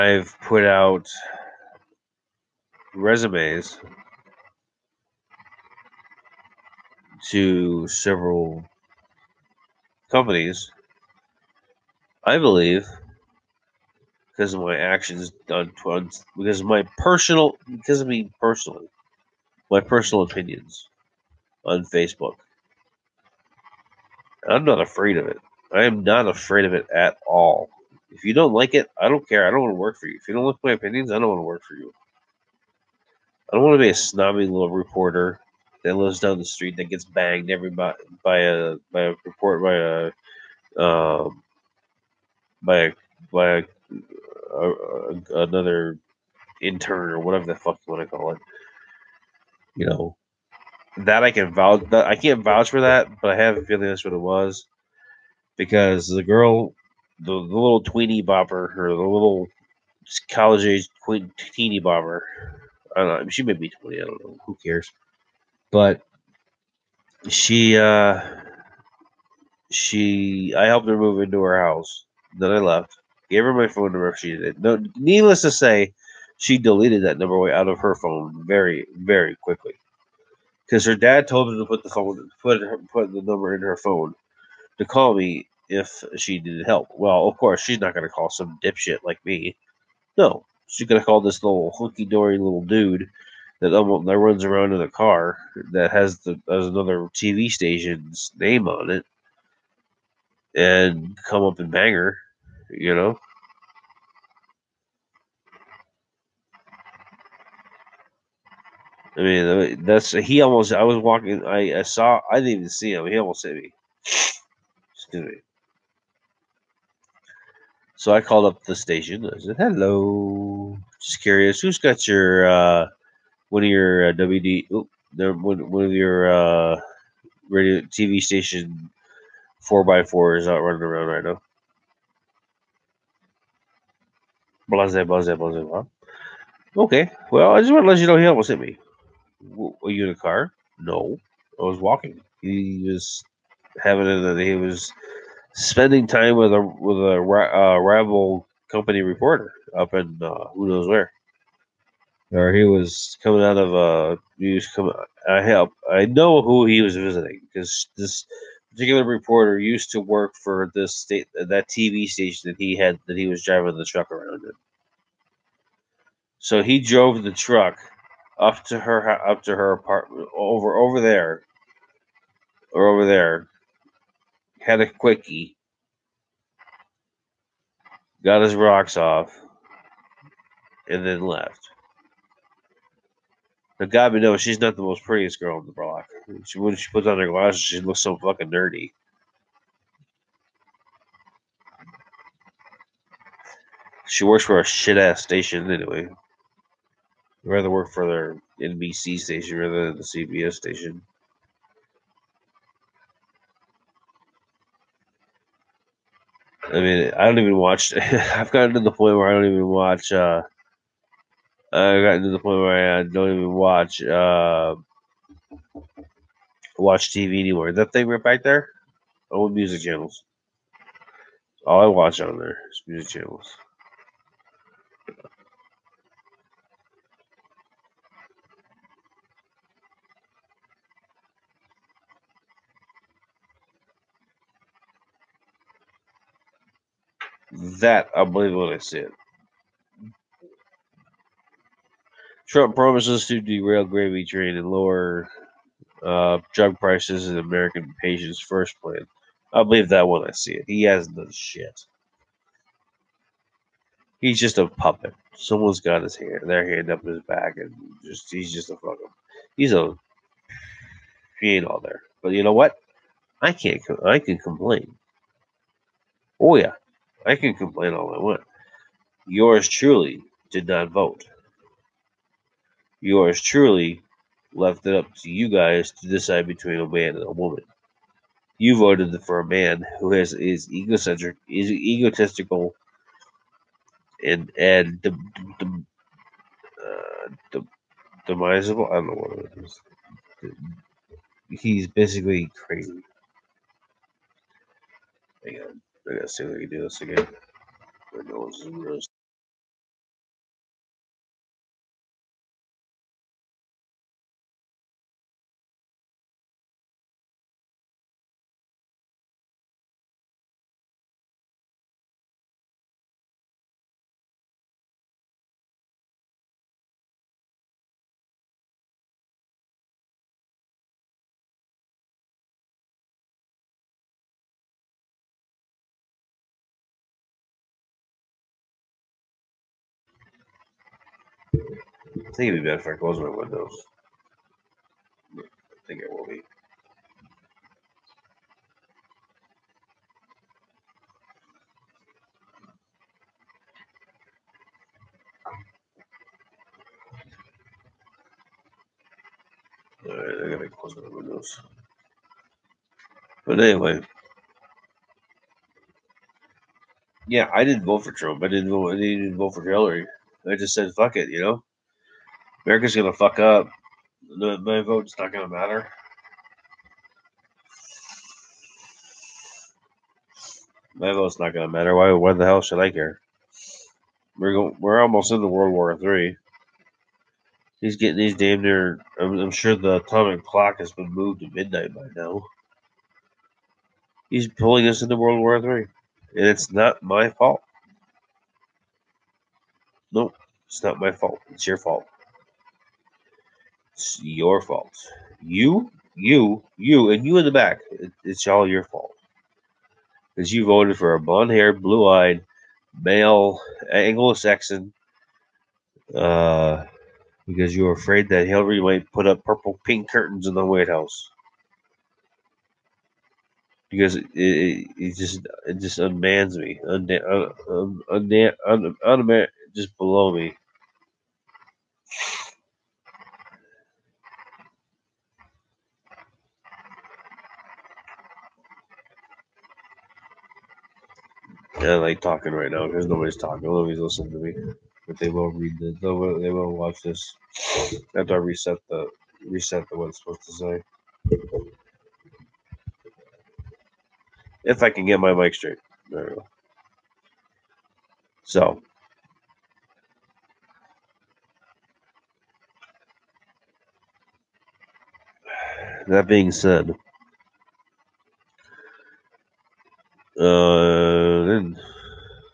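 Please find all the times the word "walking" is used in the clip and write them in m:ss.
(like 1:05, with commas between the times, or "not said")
1:50, 2:21.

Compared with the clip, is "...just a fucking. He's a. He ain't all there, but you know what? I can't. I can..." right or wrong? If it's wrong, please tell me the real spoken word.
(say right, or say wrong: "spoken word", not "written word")
right.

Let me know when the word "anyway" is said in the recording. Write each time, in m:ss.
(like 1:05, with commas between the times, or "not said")
3:15, 5:53.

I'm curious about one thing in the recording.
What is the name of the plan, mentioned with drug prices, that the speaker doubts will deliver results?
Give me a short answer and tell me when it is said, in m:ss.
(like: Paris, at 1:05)
American patients' first, at 4:07.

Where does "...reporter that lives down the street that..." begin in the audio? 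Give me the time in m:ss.
0:34.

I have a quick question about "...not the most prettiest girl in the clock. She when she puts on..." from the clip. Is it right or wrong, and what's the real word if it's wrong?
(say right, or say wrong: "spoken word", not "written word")
wrong: "block", not "clock".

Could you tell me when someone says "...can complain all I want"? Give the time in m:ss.
4:27.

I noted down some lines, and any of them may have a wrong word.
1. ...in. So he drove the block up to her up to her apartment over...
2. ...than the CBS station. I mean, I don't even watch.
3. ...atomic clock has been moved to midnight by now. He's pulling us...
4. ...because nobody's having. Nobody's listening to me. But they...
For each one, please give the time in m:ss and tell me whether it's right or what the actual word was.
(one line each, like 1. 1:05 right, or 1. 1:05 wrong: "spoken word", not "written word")
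1. 2:44 wrong: "truck", not "block"
2. 3:19 right
3. 6:19 right
4. 7:12 wrong: "talking", not "having".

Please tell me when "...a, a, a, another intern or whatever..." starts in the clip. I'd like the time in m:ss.
0:43.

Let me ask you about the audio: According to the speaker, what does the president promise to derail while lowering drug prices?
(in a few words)
gravy train.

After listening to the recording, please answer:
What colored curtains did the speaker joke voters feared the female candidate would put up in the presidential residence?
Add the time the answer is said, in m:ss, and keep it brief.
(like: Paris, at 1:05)
purple pink, at 6:49.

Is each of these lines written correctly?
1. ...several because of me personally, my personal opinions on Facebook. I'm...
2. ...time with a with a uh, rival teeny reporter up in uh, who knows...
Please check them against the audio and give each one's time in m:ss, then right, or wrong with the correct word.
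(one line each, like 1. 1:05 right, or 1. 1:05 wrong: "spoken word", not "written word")
1. 0:16 wrong: "personal", not "several"
2. 2:26 wrong: "company", not "teeny".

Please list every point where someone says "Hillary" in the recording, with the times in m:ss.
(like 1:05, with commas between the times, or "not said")
5:59, 6:48.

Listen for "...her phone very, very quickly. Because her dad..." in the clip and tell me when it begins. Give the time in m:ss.
1:17.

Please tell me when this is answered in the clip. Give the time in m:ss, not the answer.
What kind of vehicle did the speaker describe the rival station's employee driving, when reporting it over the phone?
2:09.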